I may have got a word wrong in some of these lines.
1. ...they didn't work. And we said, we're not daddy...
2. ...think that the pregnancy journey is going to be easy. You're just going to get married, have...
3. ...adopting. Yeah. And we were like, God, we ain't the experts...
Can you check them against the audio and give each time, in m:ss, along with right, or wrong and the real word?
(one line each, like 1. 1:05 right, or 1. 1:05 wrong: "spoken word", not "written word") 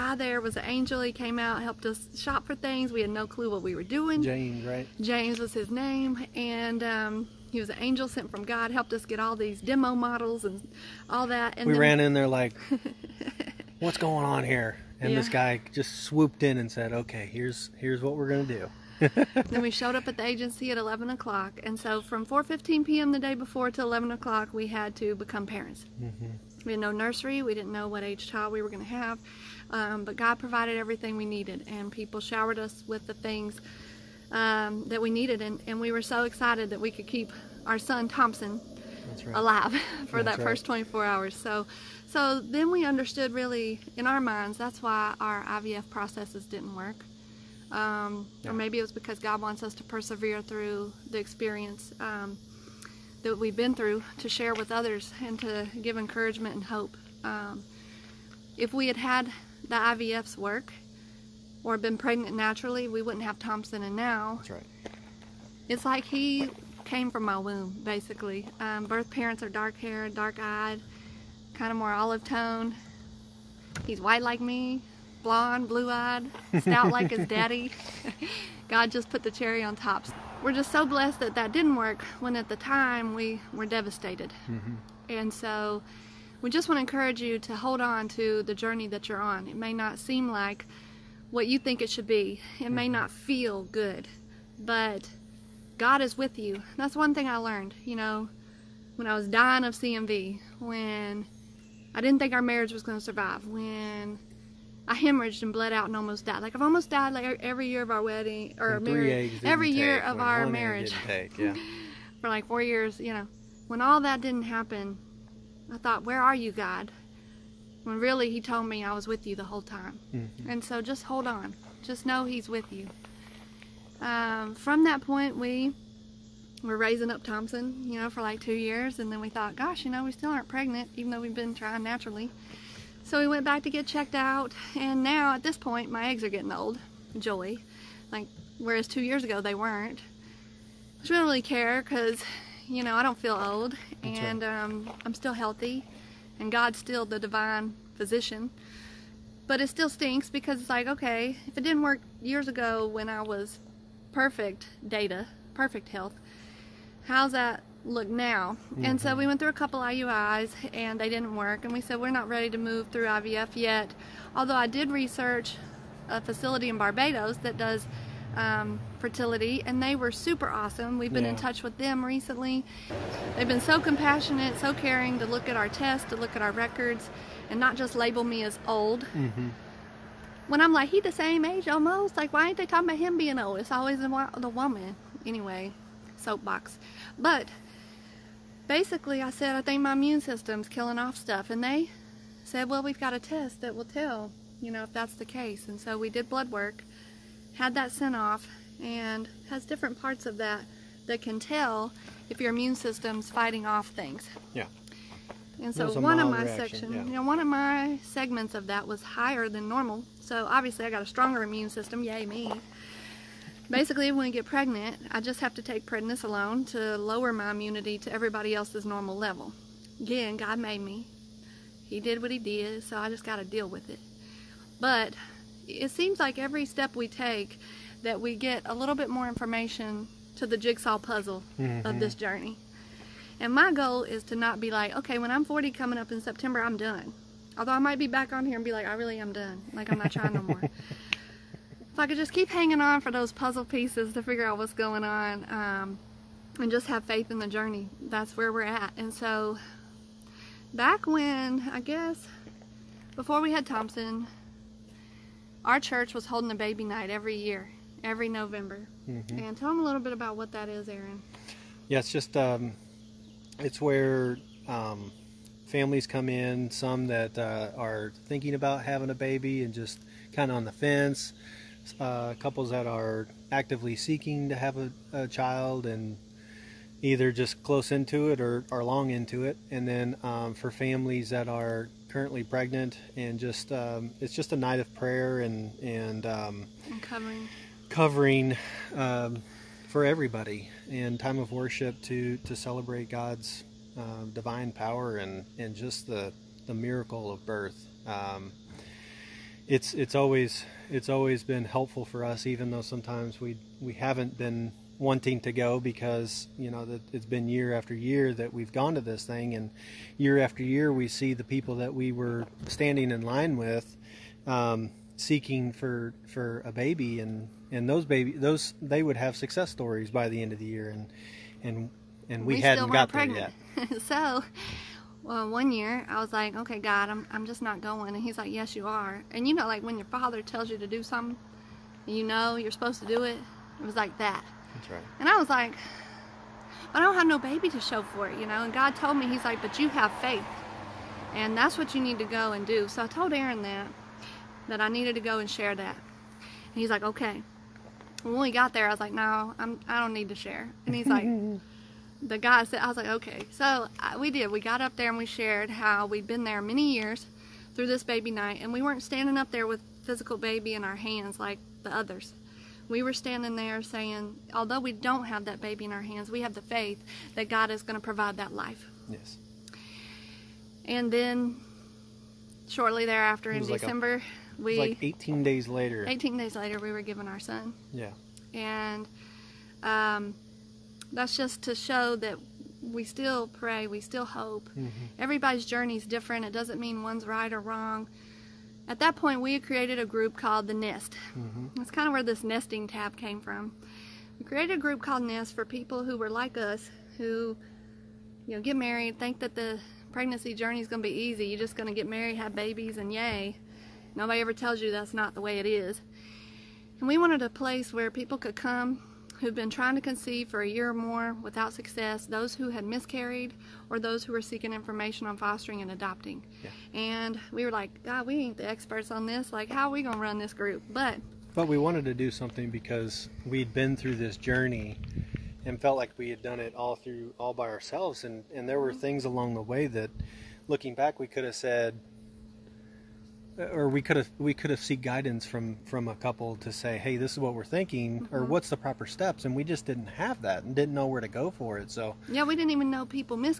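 1. 2:40 wrong: "ready", not "daddy"
2. 6:39 right
3. 6:55 right.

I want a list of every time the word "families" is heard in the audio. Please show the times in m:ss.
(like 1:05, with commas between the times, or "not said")
4:25, 4:40.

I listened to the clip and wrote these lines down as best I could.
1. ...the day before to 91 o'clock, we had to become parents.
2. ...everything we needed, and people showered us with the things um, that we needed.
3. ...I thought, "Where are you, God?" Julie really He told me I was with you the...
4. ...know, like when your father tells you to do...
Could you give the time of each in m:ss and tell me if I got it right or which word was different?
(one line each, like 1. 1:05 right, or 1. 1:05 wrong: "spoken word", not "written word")
1. 0:23 wrong: "11", not "91"
2. 0:30 right
3. 1:55 wrong: "When", not "Julie"
4. 5:29 right.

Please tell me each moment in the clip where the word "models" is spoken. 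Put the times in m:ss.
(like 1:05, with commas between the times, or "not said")
0:09.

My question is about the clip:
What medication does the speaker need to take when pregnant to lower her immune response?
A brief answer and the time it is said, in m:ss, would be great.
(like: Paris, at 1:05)
prednisolone, at 3:35.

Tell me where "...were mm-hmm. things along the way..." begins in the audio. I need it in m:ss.
7:08.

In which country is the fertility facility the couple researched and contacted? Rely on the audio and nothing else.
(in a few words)
Barbados.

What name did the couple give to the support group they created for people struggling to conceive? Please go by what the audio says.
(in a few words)
The Nest.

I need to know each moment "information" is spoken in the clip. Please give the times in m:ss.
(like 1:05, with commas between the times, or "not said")
3:49, 6:54.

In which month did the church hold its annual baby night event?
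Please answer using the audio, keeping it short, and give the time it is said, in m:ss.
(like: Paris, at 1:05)
November, at 4:18.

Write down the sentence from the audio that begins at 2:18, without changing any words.
Like, whereas two years ago, they weren't.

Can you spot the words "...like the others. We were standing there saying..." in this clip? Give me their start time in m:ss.
6:01.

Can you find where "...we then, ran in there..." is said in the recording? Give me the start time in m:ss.
0:11.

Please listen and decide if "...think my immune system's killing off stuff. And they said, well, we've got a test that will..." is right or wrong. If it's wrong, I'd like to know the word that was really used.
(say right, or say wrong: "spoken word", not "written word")
right.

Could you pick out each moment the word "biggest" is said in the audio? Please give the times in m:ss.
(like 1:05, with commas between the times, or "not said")
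not said.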